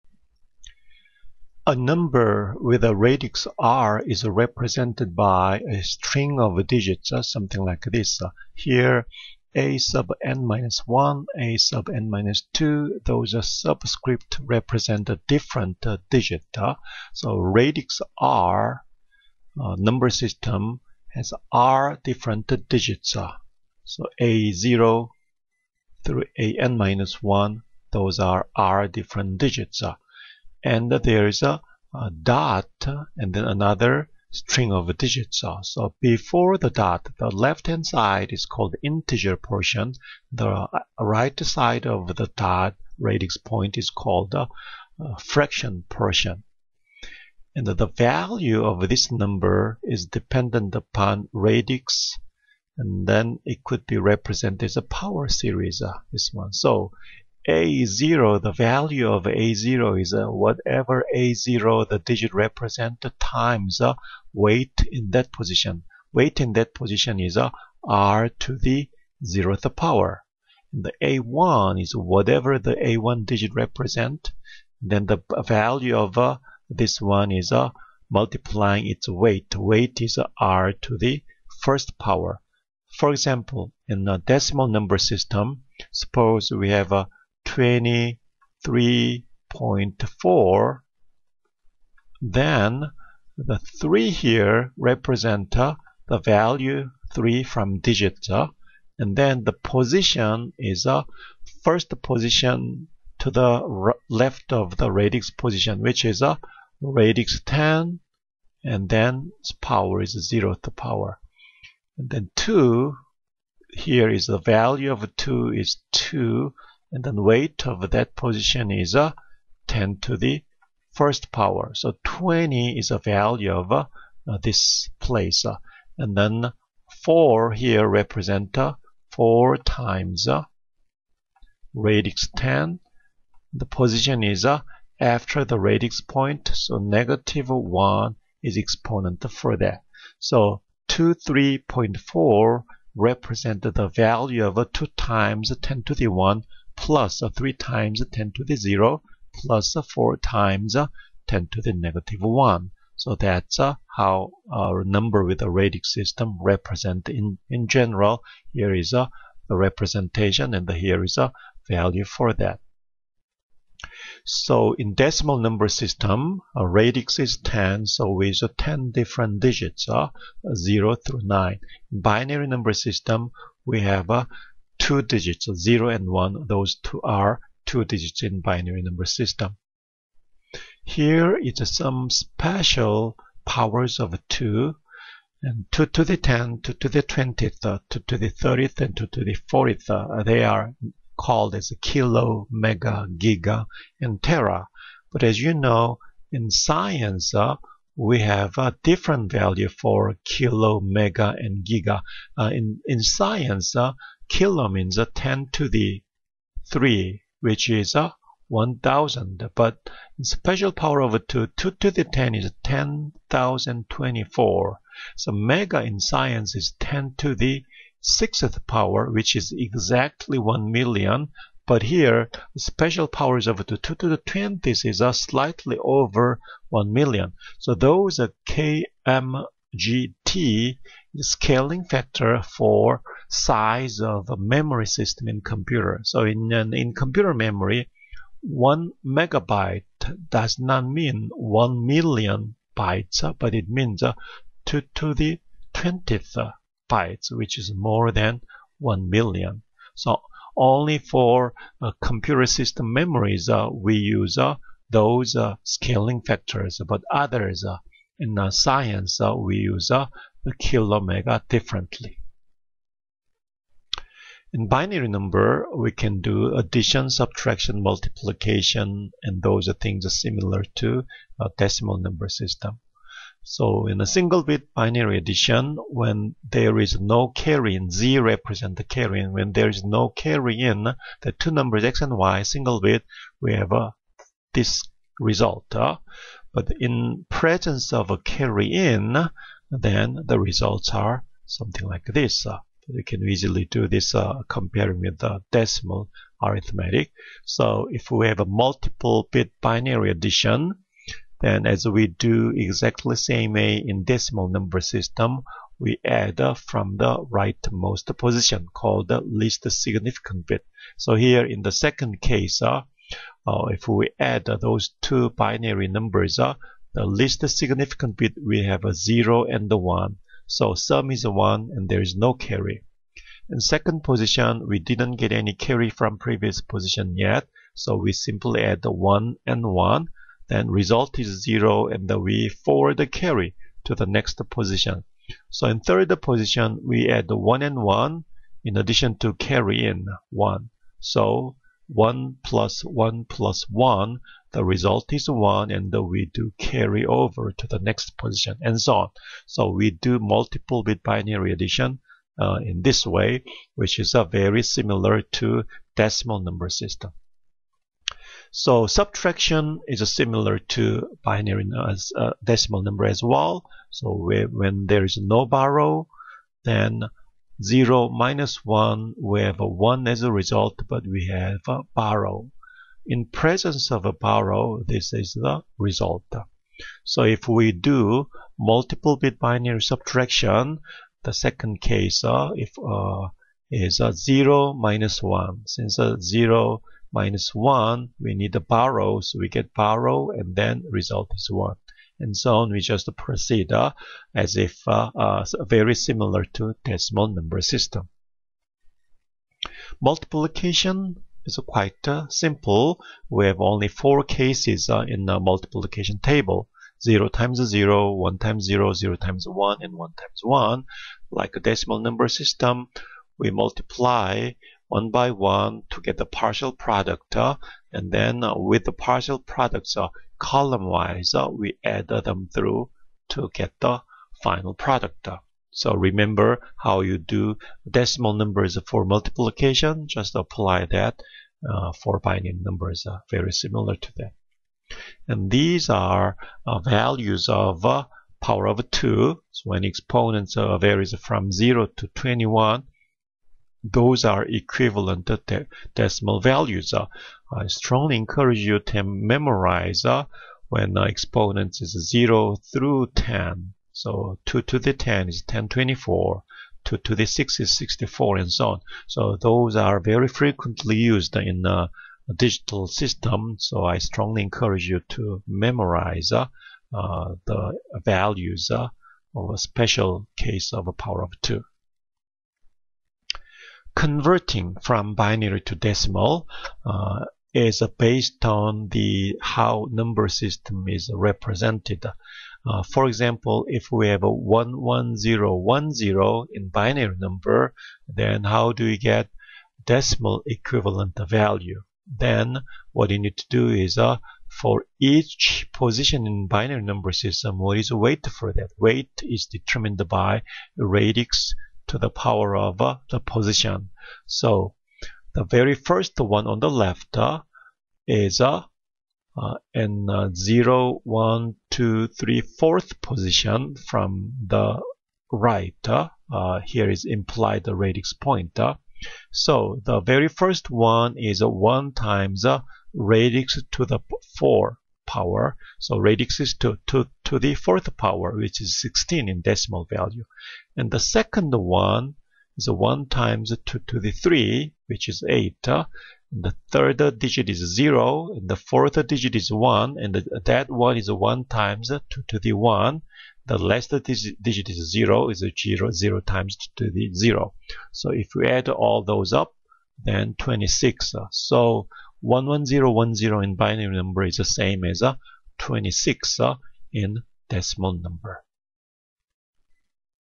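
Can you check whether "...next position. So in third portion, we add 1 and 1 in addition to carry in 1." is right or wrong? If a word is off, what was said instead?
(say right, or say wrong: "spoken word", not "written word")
wrong: "position", not "portion".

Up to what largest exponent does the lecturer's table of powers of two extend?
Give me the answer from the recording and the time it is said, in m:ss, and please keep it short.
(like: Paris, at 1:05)
21, at 7:22.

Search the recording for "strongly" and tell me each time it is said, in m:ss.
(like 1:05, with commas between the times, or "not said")
7:27, 7:43.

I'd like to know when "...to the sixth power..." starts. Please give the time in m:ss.
3:37.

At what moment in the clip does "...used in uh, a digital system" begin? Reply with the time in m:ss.
7:40.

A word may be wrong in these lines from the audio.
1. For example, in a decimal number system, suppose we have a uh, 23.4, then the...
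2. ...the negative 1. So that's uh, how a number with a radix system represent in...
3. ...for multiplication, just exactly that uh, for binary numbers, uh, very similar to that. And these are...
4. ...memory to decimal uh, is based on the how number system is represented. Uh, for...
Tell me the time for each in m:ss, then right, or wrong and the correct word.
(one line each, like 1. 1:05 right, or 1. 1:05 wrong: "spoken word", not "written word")
1. 1:22 right
2. 2:31 right
3. 7:08 wrong: "apply", not "exactly"
4. 7:55 wrong: "binary", not "memory".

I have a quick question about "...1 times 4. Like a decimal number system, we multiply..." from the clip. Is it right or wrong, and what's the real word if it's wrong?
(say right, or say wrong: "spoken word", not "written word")
wrong: "1", not "4".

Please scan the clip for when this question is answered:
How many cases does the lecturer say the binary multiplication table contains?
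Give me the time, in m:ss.
6:43.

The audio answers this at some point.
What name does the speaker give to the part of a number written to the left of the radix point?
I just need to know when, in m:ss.
0:38.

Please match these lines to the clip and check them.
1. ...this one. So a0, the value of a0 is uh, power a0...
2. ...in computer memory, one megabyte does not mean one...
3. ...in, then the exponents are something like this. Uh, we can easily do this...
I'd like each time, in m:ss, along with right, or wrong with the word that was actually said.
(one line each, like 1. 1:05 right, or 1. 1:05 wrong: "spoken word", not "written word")
1. 0:56 wrong: "whatever", not "power"
2. 3:56 right
3. 4:48 wrong: "results", not "exponents".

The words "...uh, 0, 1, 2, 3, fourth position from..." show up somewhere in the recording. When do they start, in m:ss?
8:30.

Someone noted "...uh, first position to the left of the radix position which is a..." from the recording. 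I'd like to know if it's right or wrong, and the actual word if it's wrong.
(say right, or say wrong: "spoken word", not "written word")
right.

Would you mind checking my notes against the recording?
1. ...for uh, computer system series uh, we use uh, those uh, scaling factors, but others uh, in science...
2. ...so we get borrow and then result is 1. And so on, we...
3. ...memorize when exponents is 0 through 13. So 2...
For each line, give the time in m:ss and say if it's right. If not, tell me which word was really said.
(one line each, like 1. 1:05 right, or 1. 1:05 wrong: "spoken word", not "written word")
1. 4:10 wrong: "memories", not "series"
2. 6:29 right
3. 7:29 wrong: "10", not "13".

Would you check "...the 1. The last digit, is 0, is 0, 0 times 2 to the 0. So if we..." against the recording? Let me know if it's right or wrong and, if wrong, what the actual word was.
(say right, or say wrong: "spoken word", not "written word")
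right.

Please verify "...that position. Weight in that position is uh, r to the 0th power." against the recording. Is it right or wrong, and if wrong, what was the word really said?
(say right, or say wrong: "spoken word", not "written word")
right.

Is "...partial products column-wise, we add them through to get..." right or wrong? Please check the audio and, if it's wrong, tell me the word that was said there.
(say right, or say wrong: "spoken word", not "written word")
right.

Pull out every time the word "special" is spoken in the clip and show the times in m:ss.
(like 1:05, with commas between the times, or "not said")
3:02, 3:30, 3:42, 7:49.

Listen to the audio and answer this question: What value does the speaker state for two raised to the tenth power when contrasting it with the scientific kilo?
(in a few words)
10,024.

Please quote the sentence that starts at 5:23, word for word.
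In second position, we didn't get any carry from previous position yet.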